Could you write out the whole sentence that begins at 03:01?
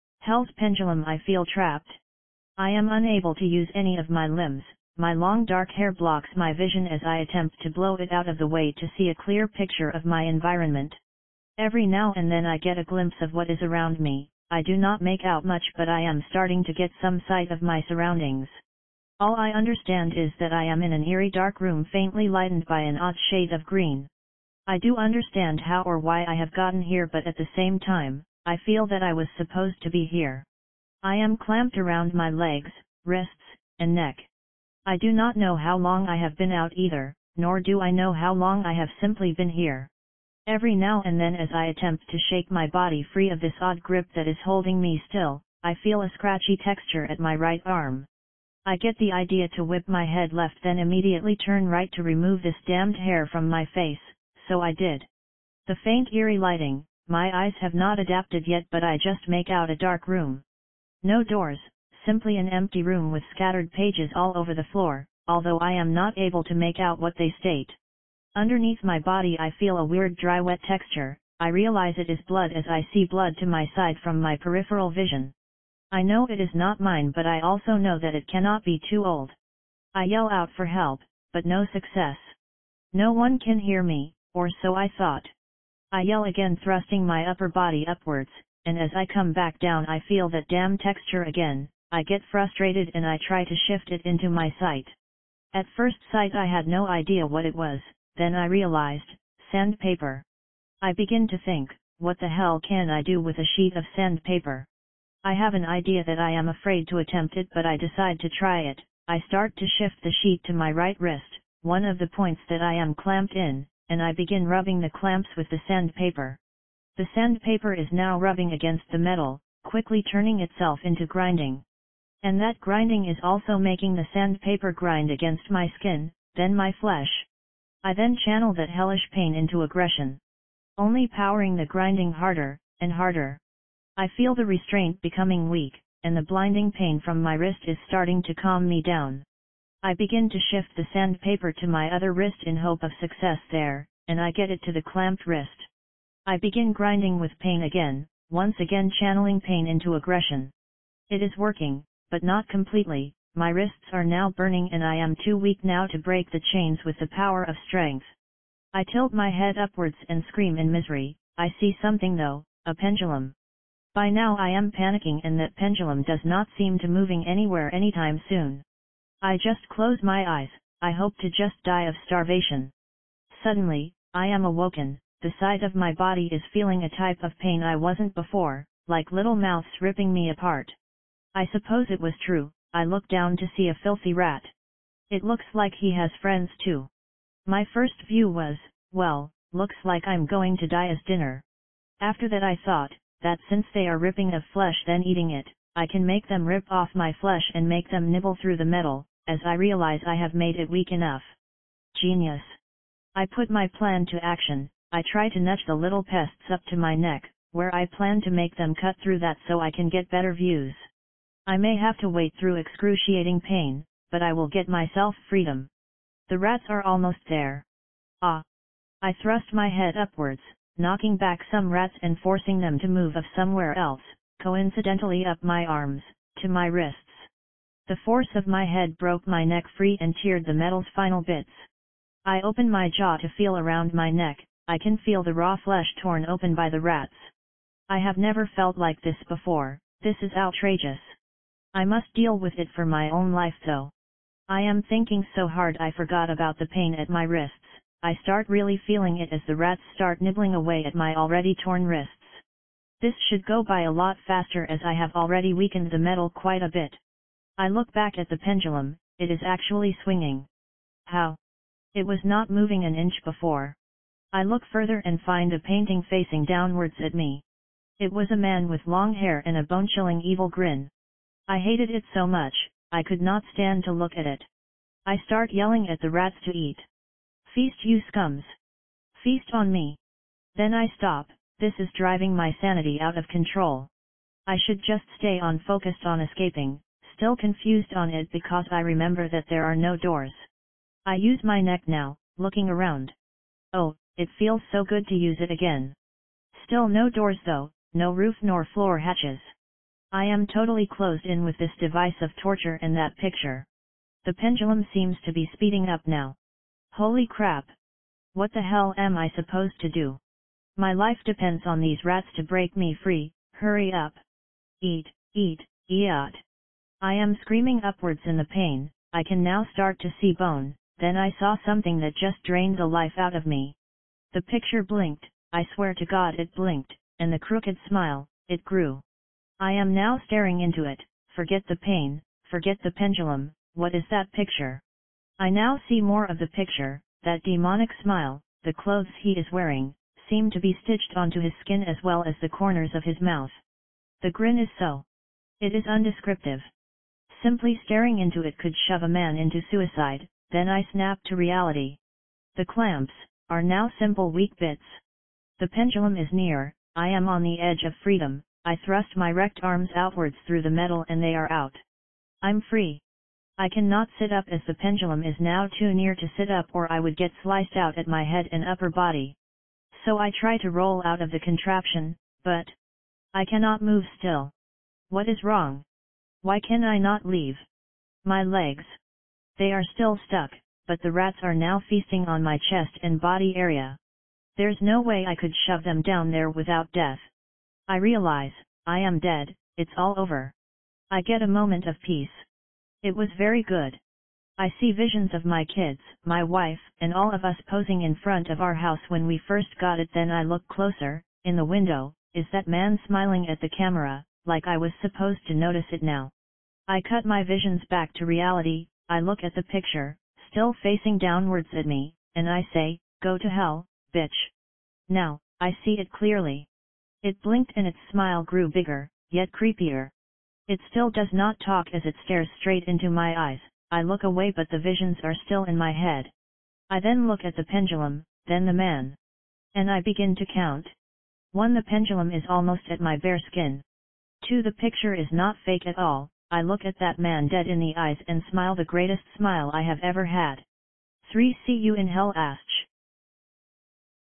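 I suppose it was true, I look down to see a filthy rat.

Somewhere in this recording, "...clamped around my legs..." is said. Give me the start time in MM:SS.
00:31.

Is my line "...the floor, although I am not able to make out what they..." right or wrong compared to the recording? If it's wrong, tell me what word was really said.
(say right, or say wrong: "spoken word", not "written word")
right.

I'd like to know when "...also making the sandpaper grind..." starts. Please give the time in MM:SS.
02:03.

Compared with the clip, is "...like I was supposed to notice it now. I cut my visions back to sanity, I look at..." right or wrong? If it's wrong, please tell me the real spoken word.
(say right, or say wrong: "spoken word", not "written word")
wrong: "reality", not "sanity".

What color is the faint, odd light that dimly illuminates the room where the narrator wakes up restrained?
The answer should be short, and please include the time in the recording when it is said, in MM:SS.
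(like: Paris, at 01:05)
Green, at 00:23.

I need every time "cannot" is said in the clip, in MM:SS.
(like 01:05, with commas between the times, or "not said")
01:18, 06:03, 06:13.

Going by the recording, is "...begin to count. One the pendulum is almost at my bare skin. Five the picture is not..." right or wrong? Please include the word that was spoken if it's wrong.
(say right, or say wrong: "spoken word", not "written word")
wrong: "Two", not "Five".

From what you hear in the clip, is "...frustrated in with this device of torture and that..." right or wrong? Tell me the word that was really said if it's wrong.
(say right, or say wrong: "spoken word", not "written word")
wrong: "closed", not "frustrated".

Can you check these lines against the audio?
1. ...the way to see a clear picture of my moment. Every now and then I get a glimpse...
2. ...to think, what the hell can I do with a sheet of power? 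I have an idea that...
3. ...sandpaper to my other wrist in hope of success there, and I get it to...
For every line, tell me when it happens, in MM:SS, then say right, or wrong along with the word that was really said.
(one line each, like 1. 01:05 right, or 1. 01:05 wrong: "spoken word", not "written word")
1. 00:08 wrong: "environment", not "moment"
2. 01:41 wrong: "sandpaper", not "power"
3. 02:20 right.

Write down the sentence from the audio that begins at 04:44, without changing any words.
I should just stay on focused on escaping, still confused on it because I remember that there are no doors.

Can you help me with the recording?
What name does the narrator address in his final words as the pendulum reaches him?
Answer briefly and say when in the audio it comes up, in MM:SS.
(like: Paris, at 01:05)
Ash, at 07:22.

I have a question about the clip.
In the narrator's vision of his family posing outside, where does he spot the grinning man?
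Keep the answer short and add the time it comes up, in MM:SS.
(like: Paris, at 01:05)
In the window, at 06:41.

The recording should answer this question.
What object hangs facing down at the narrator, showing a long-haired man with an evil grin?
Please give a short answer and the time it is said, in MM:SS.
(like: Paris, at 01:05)
A painting, at 04:25.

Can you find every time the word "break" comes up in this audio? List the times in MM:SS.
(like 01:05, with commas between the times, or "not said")
02:35, 05:12.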